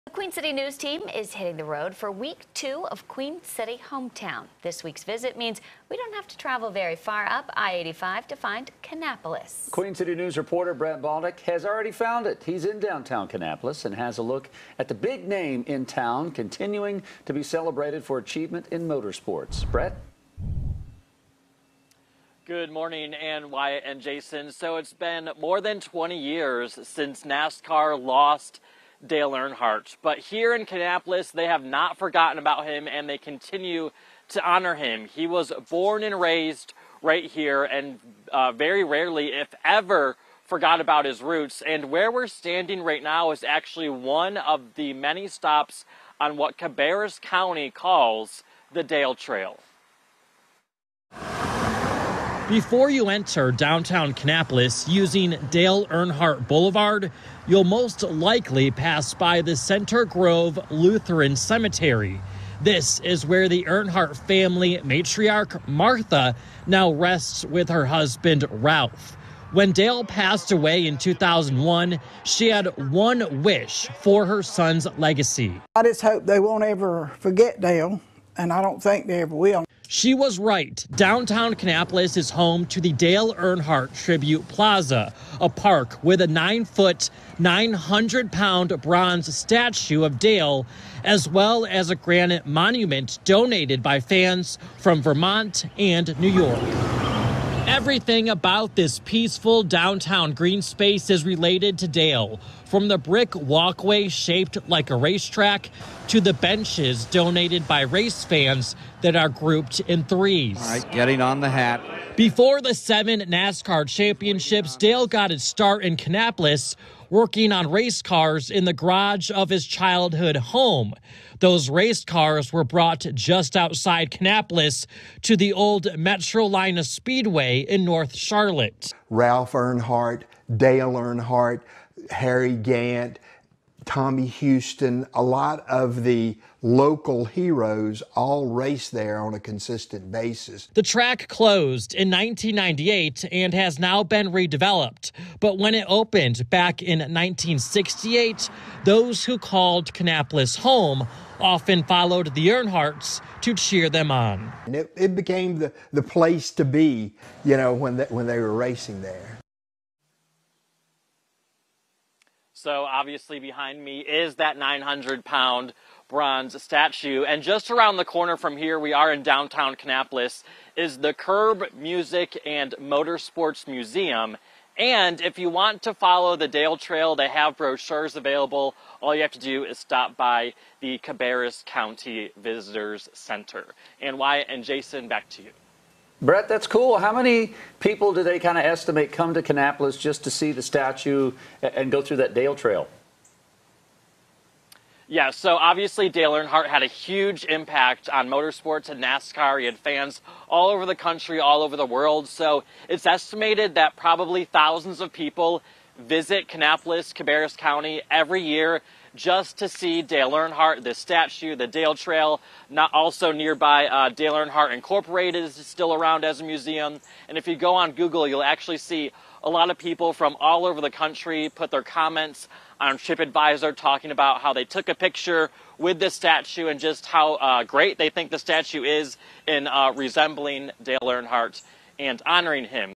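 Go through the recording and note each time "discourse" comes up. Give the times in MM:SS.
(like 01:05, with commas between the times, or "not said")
not said.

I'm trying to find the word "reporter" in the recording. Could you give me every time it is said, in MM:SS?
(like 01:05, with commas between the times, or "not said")
00:10.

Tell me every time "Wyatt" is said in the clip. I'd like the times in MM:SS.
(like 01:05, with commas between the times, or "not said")
00:23, 03:04.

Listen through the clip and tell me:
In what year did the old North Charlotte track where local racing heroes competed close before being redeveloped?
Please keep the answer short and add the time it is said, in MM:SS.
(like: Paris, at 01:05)
1998, at 02:22.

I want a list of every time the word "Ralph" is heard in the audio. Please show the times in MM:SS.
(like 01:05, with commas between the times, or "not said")
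01:08, 02:09.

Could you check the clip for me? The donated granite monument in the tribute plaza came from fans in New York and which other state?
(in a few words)
Vermont.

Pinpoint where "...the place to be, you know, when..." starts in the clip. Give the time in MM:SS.
02:35.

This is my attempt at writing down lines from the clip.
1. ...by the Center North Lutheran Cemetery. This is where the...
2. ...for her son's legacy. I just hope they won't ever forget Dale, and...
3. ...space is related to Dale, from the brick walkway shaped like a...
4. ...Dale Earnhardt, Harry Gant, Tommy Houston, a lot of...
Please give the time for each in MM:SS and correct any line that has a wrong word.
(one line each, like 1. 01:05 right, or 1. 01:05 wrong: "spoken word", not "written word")
1. 00:59 wrong: "Grove", not "North"
2. 01:14 right
3. 01:40 right
4. 02:10 right.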